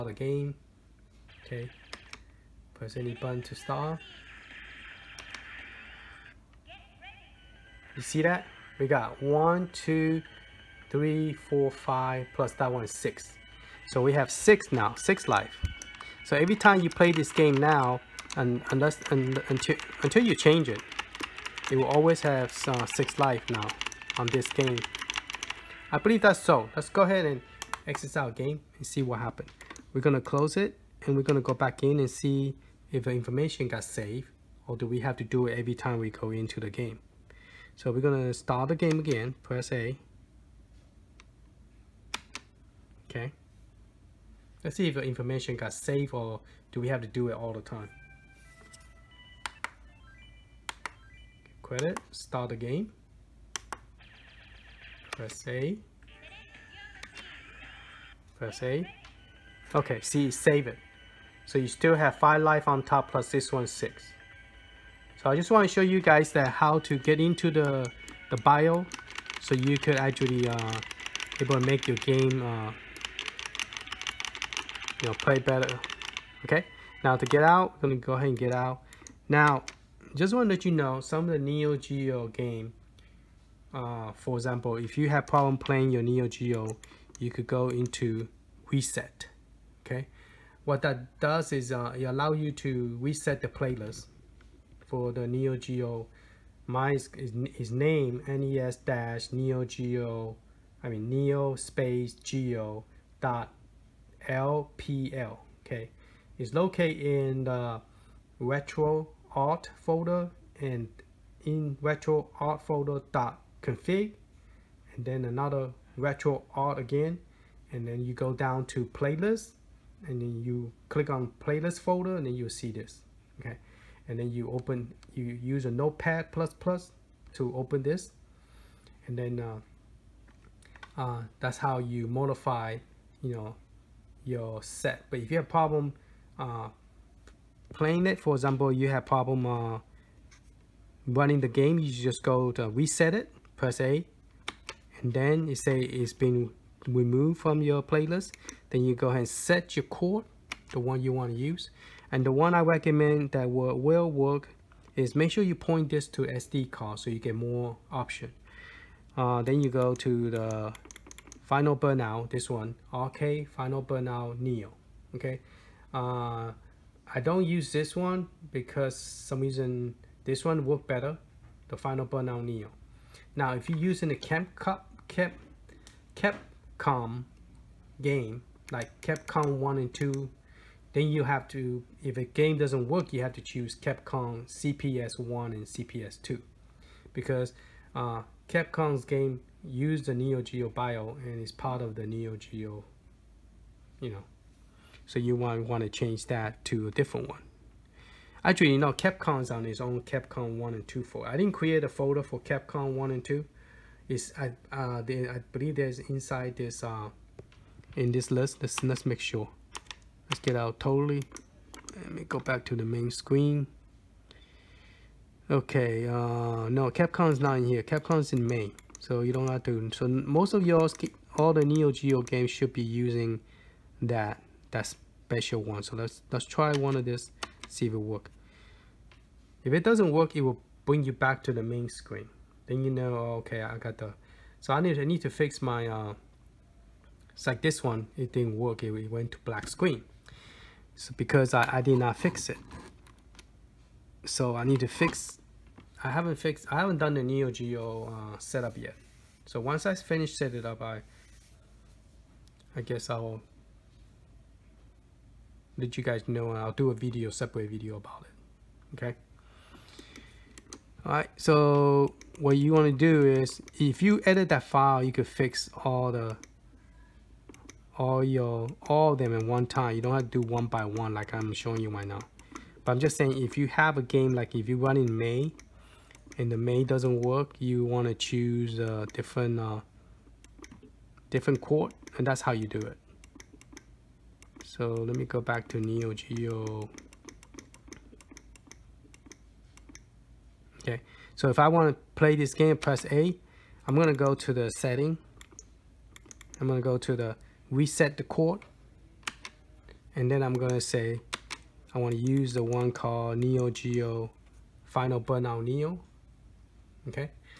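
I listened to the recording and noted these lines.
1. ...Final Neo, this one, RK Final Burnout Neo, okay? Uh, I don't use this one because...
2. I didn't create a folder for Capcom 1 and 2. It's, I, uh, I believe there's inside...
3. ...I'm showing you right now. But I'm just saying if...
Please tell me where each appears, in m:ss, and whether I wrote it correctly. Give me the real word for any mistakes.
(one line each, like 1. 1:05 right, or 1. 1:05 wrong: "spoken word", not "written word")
1. 2:41 wrong: "Burnout", not "Neo"
2. 3:21 right
3. 4:31 right.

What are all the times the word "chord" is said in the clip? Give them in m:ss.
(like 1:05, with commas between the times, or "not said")
2:29.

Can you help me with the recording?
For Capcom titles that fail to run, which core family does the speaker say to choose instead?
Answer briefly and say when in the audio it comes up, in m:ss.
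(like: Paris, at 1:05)
Capcom CPS 1 and CPS 2, at 3:03.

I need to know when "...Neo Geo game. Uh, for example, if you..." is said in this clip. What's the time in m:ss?
1:21.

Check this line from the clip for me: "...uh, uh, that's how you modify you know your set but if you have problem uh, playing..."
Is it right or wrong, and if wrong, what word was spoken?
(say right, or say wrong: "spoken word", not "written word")
right.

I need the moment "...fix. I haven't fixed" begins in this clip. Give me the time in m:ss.
4:04.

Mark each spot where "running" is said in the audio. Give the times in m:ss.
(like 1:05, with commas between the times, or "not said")
2:21.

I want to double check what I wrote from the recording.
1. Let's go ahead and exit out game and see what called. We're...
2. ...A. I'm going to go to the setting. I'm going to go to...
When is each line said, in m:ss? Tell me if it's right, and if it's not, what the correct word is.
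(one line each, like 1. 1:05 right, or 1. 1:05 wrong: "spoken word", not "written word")
1. 0:26 wrong: "happened", not "called"
2. 4:53 right.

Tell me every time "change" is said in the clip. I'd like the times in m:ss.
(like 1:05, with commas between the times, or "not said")
0:20, 3:15.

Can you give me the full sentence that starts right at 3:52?
Then you know, oh, okay, I got the.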